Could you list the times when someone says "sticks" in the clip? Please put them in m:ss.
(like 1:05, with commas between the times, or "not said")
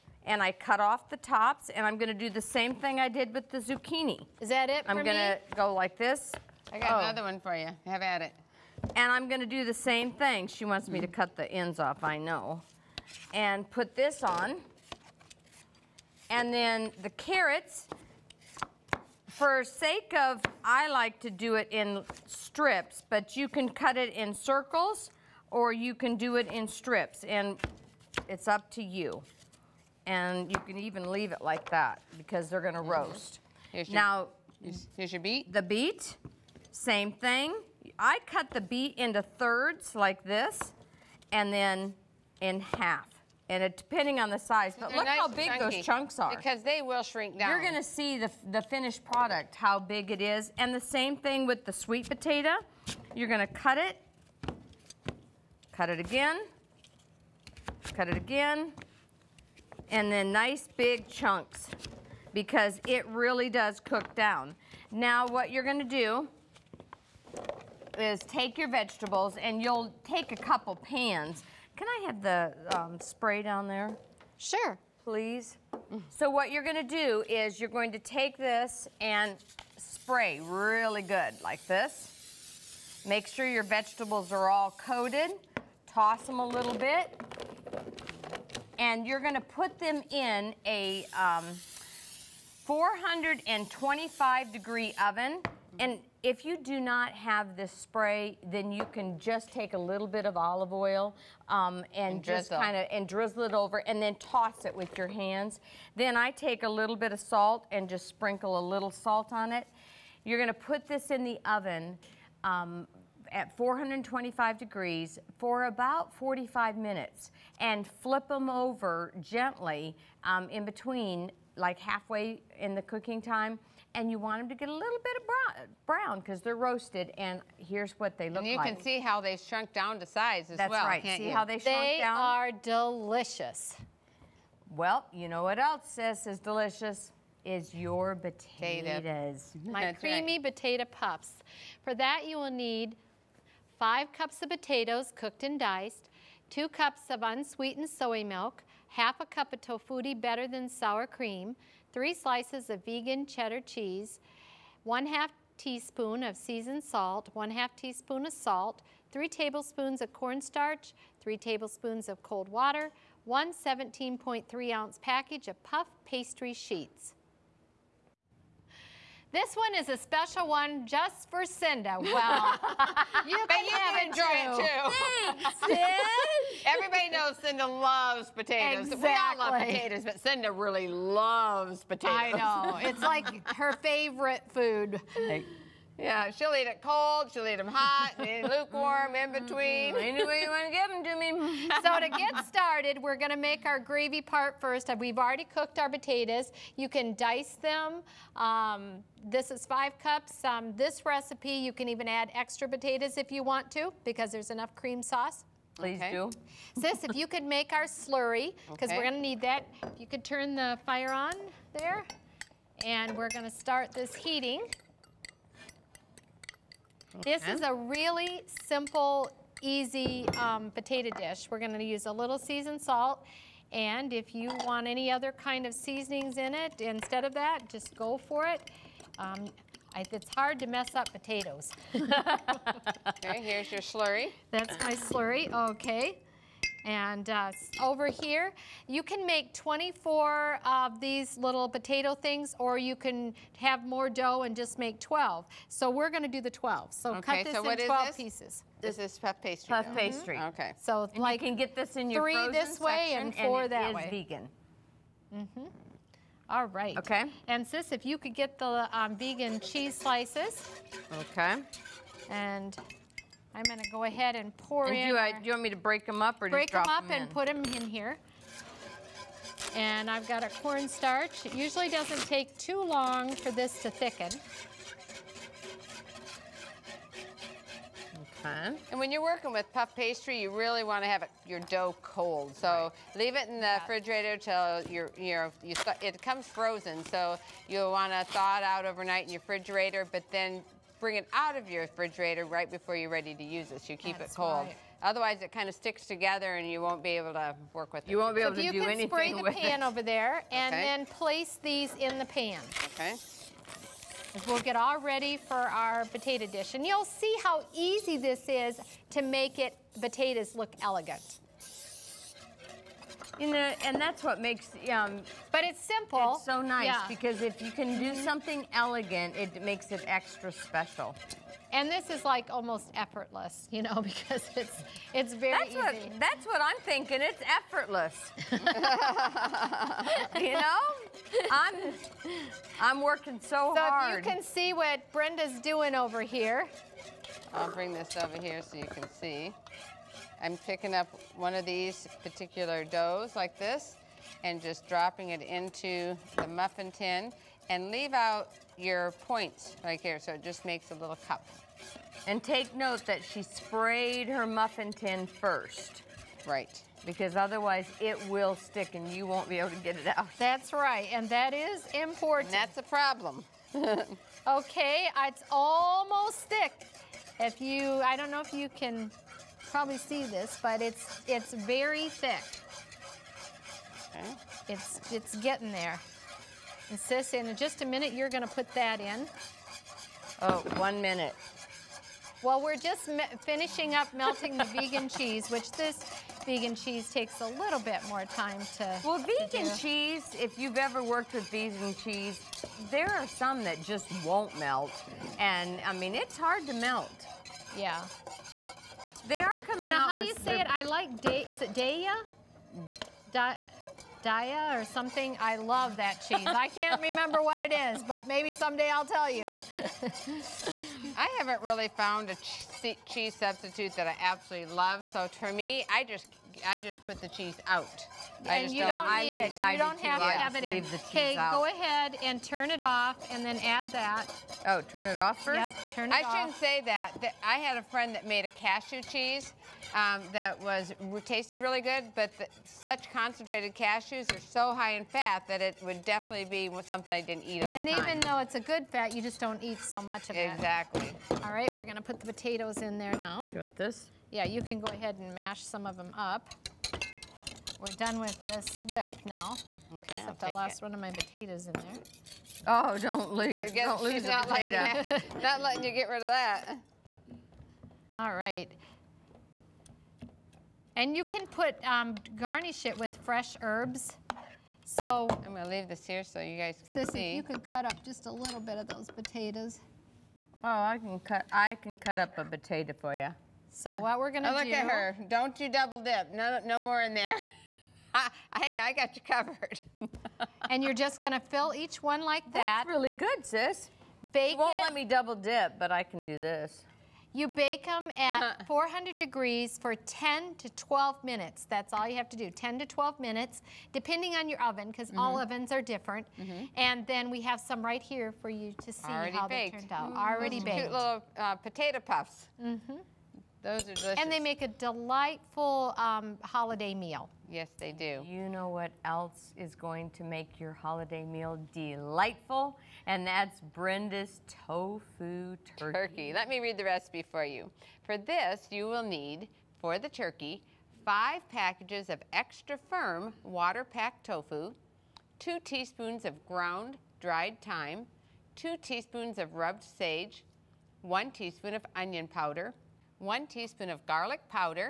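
4:55, 5:58.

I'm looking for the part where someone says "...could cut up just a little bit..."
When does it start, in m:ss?
7:47.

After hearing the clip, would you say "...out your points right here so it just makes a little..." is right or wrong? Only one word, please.
right.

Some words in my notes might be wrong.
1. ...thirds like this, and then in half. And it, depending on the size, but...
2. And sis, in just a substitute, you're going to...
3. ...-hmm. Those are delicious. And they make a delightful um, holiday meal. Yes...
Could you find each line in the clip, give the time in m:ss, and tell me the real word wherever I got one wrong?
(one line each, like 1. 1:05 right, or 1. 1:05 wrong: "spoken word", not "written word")
1. 0:39 right
2. 6:16 wrong: "minute", not "substitute"
3. 8:22 right.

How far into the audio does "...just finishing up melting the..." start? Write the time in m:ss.
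6:22.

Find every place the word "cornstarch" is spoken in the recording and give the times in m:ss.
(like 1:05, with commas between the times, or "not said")
2:40, 4:30.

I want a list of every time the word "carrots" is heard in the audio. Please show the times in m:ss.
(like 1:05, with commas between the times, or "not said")
0:17.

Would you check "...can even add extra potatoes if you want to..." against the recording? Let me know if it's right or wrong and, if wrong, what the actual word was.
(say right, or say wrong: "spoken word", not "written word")
right.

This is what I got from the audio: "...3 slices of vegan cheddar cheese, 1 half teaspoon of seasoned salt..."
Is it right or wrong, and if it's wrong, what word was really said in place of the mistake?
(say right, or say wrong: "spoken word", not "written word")
right.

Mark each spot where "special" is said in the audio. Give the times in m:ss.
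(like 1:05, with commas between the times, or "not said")
2:49, 5:20.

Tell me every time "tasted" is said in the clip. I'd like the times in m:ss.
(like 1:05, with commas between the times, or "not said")
7:11.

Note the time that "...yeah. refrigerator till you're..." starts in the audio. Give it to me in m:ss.
4:43.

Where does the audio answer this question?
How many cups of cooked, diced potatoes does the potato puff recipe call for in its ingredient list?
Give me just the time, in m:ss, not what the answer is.
2:23.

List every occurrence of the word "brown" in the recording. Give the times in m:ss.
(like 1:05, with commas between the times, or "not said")
2:05.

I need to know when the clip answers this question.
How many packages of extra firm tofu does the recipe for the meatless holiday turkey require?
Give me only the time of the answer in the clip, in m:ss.
8:41.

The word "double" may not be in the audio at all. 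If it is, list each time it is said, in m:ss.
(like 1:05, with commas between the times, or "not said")
7:55, 8:05.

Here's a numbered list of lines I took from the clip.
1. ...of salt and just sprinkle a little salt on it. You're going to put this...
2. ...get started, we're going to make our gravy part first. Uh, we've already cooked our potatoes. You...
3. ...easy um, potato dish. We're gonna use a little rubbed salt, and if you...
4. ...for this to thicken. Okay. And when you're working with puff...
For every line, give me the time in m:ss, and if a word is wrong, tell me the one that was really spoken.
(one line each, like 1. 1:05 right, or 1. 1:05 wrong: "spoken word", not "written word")
1. 1:47 right
2. 3:12 right
3. 3:39 wrong: "seasoned", not "rubbed"
4. 4:33 right.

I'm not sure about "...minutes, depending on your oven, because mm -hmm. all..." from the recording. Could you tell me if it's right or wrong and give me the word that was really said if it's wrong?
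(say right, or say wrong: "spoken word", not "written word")
right.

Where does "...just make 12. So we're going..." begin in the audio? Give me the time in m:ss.
4:04.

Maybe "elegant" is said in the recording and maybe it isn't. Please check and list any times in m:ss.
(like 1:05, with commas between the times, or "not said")
5:10, 5:18.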